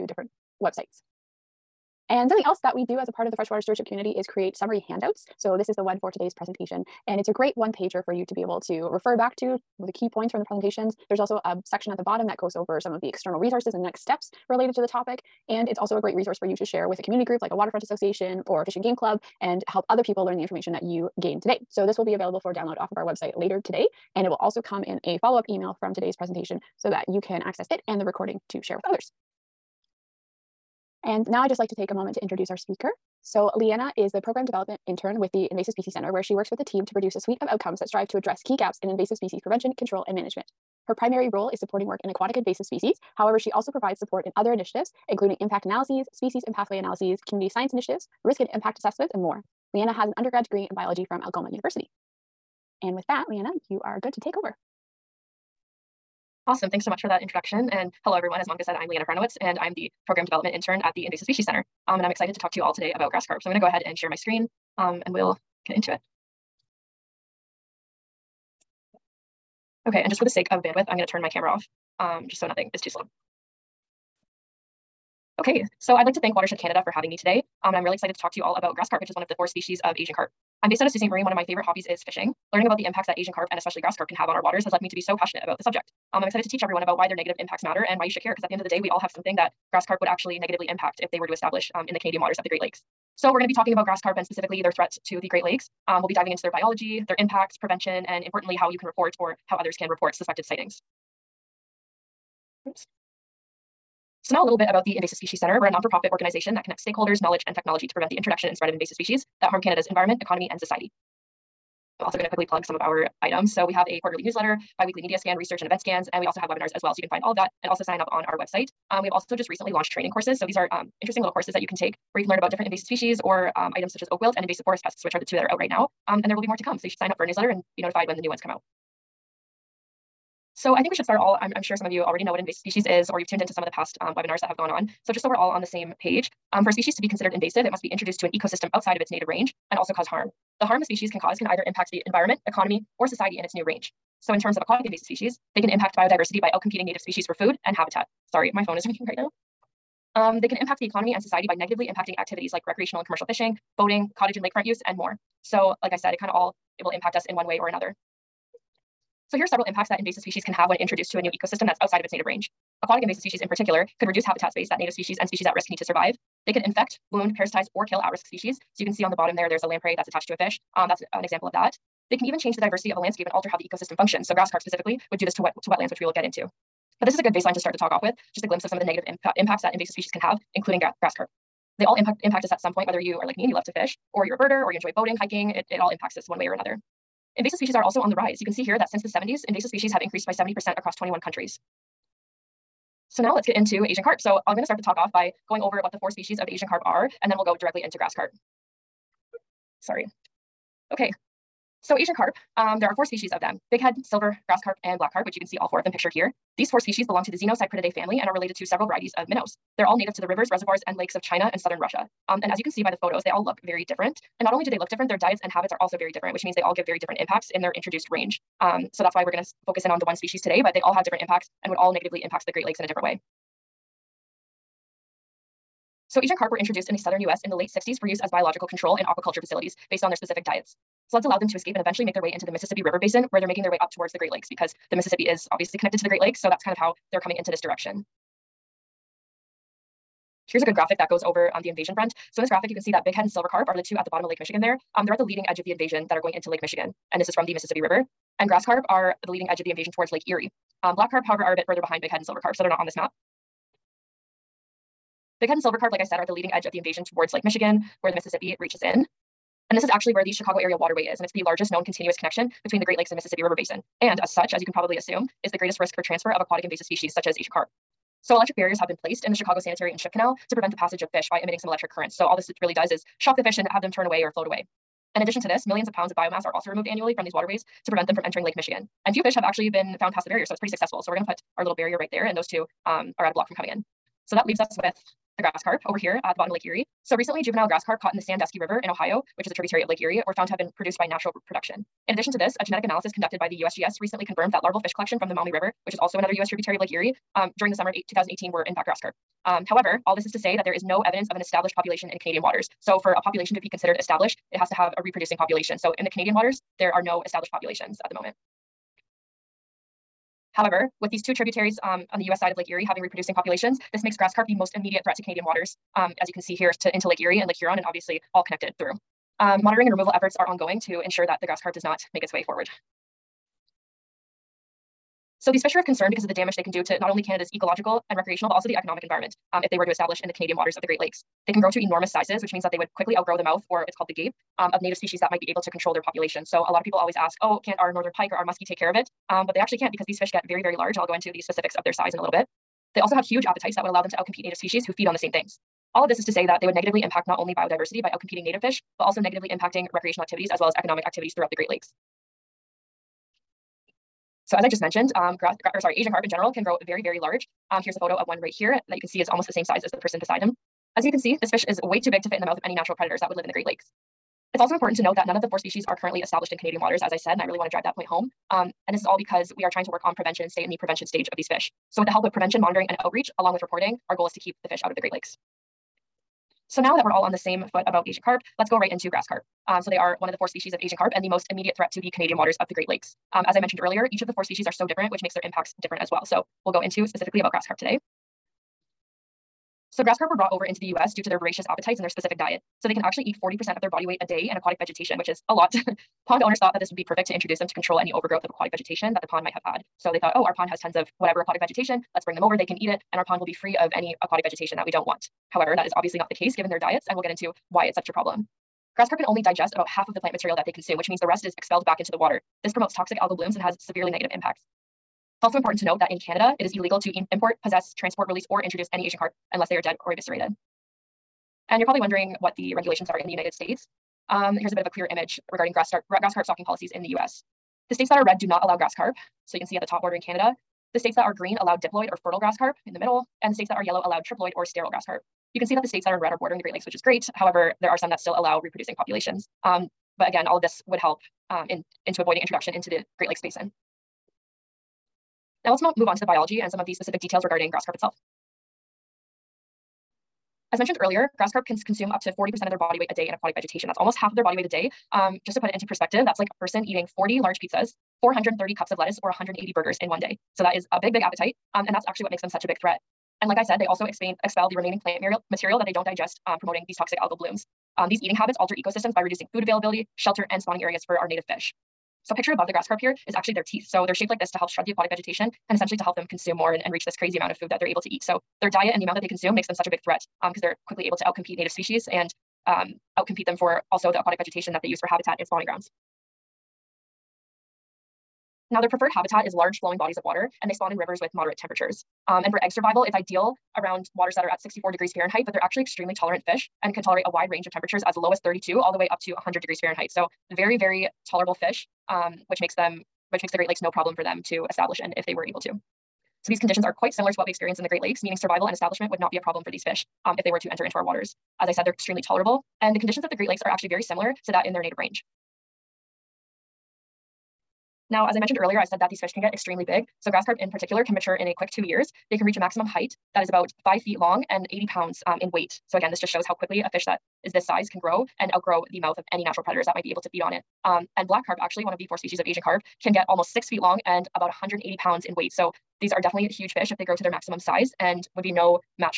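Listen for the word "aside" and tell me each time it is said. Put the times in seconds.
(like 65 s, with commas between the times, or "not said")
not said.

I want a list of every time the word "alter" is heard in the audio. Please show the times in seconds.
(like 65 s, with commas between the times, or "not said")
173 s, 468 s.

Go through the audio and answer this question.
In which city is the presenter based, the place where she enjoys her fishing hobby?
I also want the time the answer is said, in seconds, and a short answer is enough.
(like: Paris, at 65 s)
Sault Ste. Marie, at 80 s.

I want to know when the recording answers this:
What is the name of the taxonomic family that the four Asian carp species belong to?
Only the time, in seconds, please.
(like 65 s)
207 s.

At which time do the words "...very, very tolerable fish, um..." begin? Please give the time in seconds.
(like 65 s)
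500 s.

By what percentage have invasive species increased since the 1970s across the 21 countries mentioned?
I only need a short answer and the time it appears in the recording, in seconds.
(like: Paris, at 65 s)
70%, at 190 s.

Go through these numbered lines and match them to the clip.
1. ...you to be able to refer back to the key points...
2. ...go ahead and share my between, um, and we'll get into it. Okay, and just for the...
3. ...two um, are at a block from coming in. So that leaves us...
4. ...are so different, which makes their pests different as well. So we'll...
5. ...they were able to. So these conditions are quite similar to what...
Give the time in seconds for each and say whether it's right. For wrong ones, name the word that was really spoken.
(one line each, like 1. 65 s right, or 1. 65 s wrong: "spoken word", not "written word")
1. 8 s right
2. 63 s wrong: "screen", not "between"
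3. 282 s right
4. 384 s wrong: "impacts", not "pests"
5. 505 s right.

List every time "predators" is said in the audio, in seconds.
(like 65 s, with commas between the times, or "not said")
362 s, 529 s.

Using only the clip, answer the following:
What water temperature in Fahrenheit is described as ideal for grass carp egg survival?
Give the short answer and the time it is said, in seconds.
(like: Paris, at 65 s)
64 degrees Fahrenheit, at 494 s.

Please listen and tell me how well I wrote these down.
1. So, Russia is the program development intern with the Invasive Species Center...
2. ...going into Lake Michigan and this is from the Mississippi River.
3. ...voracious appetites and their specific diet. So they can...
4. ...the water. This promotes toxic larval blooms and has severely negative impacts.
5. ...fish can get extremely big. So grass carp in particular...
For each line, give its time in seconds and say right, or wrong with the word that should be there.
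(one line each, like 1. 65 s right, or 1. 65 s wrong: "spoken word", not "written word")
1. 33 s wrong: "Liana", not "Russia"
2. 246 s right
3. 391 s right
4. 412 s wrong: "algal", not "larval"
5. 519 s right.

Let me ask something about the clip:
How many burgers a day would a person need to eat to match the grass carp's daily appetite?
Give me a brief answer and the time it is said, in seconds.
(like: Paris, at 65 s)
180, at 459 s.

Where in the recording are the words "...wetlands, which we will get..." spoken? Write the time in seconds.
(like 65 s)
175 s.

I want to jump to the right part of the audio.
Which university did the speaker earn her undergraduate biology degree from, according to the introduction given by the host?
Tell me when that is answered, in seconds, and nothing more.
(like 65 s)
51 s.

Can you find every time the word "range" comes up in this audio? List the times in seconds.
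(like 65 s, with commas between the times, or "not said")
139 s, 143 s, 162 s, 218 s, 497 s, 514 s.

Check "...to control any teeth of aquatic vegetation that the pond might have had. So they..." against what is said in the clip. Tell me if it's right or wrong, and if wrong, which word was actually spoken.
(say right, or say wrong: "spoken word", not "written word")
wrong: "overgrowth", not "teeth".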